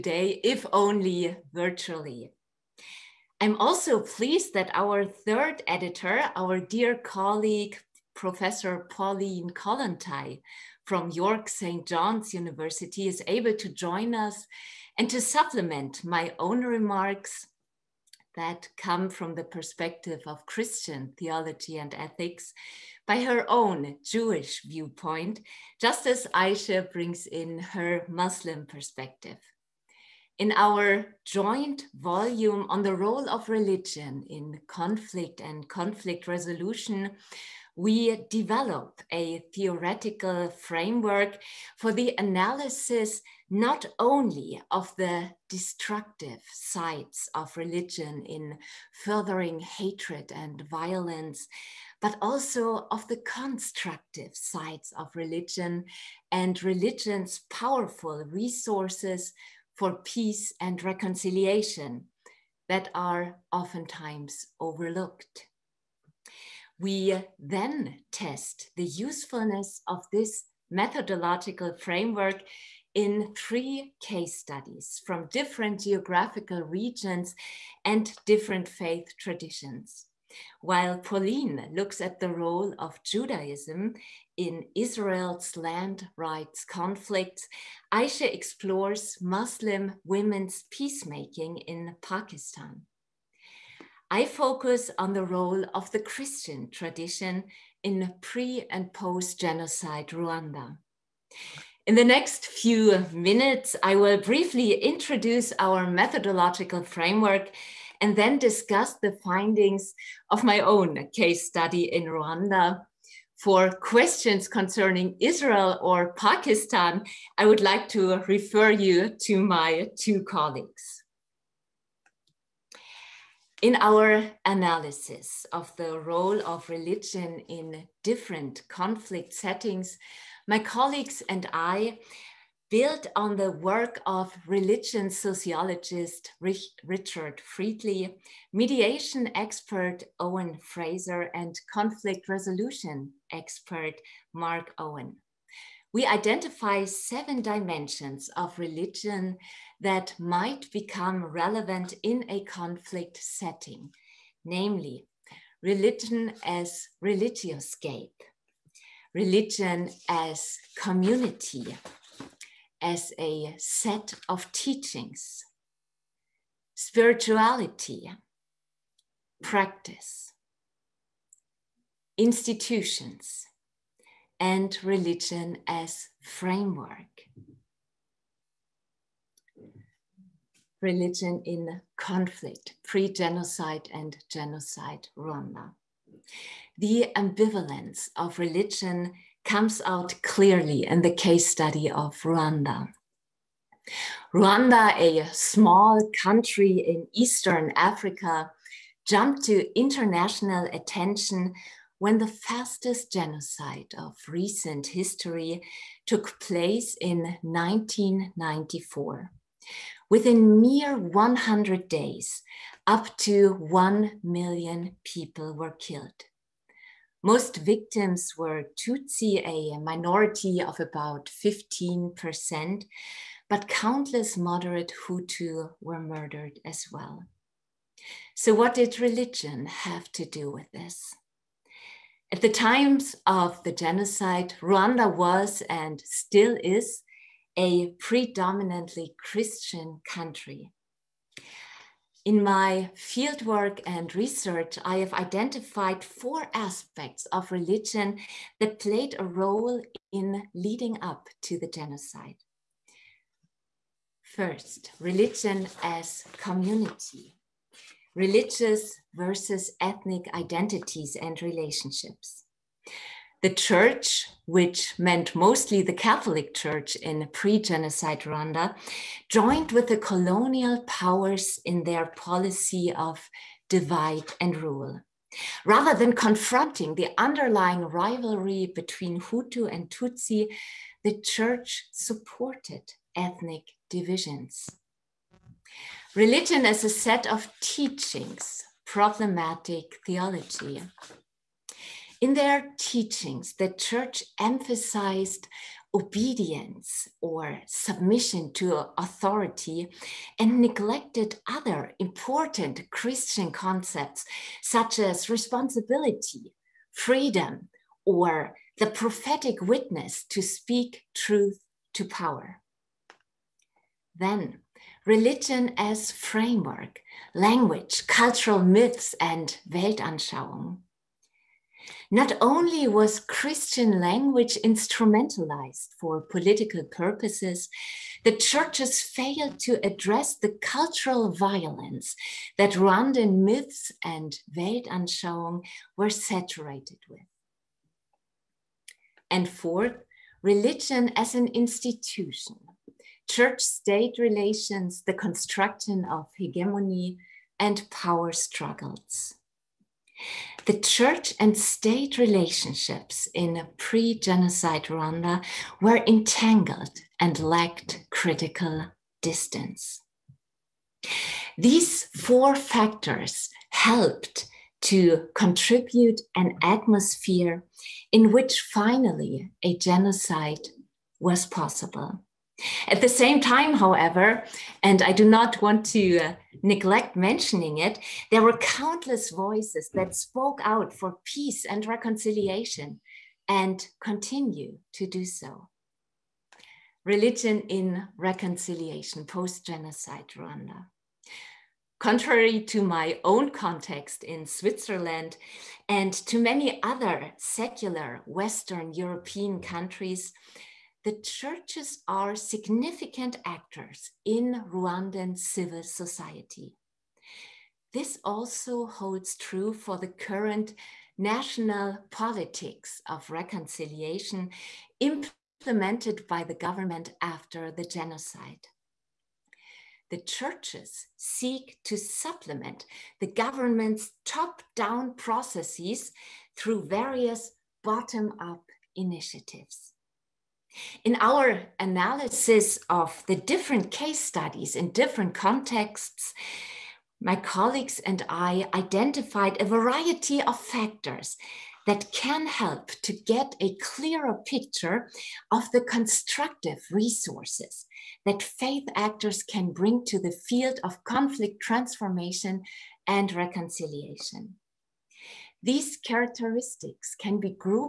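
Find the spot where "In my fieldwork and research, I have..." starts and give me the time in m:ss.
4:02.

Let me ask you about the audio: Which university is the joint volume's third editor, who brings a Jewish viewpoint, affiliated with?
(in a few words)
York St. John's University.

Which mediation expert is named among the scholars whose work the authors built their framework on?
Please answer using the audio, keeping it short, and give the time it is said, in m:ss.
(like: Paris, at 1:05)
Owen Frazer, at 2:20.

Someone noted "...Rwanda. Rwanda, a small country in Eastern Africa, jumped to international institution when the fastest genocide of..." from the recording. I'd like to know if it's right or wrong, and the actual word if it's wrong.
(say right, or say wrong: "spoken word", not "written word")
wrong: "attention", not "institution".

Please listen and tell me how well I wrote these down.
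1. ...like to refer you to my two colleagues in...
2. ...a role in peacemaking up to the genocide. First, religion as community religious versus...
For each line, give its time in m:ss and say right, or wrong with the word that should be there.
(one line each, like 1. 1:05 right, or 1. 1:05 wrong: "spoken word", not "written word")
1. 1:57 right
2. 4:09 wrong: "leading", not "peacemaking".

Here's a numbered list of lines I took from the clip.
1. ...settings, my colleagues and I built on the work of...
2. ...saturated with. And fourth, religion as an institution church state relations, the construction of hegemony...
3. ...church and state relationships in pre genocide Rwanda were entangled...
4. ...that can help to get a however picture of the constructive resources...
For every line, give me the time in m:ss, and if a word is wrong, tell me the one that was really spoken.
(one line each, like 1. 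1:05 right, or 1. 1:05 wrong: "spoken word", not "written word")
1. 2:09 right
2. 5:36 right
3. 5:50 right
4. 7:21 wrong: "clearer", not "however".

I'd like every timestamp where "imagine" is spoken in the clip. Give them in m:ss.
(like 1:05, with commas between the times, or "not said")
not said.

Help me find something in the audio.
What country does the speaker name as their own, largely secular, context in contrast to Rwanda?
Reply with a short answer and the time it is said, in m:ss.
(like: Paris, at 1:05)
Switzerland, at 6:34.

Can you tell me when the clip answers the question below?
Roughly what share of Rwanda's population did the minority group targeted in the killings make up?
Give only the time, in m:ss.
3:41.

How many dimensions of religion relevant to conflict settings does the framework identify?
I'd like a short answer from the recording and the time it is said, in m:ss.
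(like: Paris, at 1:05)
7, at 2:26.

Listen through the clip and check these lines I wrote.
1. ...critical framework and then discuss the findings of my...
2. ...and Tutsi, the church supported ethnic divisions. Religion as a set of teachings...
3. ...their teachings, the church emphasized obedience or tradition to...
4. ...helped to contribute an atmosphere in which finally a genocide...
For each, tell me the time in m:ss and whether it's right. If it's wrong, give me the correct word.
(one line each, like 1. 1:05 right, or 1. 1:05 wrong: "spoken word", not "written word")
1. 1:45 wrong: "methodological", not "critical"
2. 4:39 right
3. 4:52 wrong: "submission", not "tradition"
4. 6:03 right.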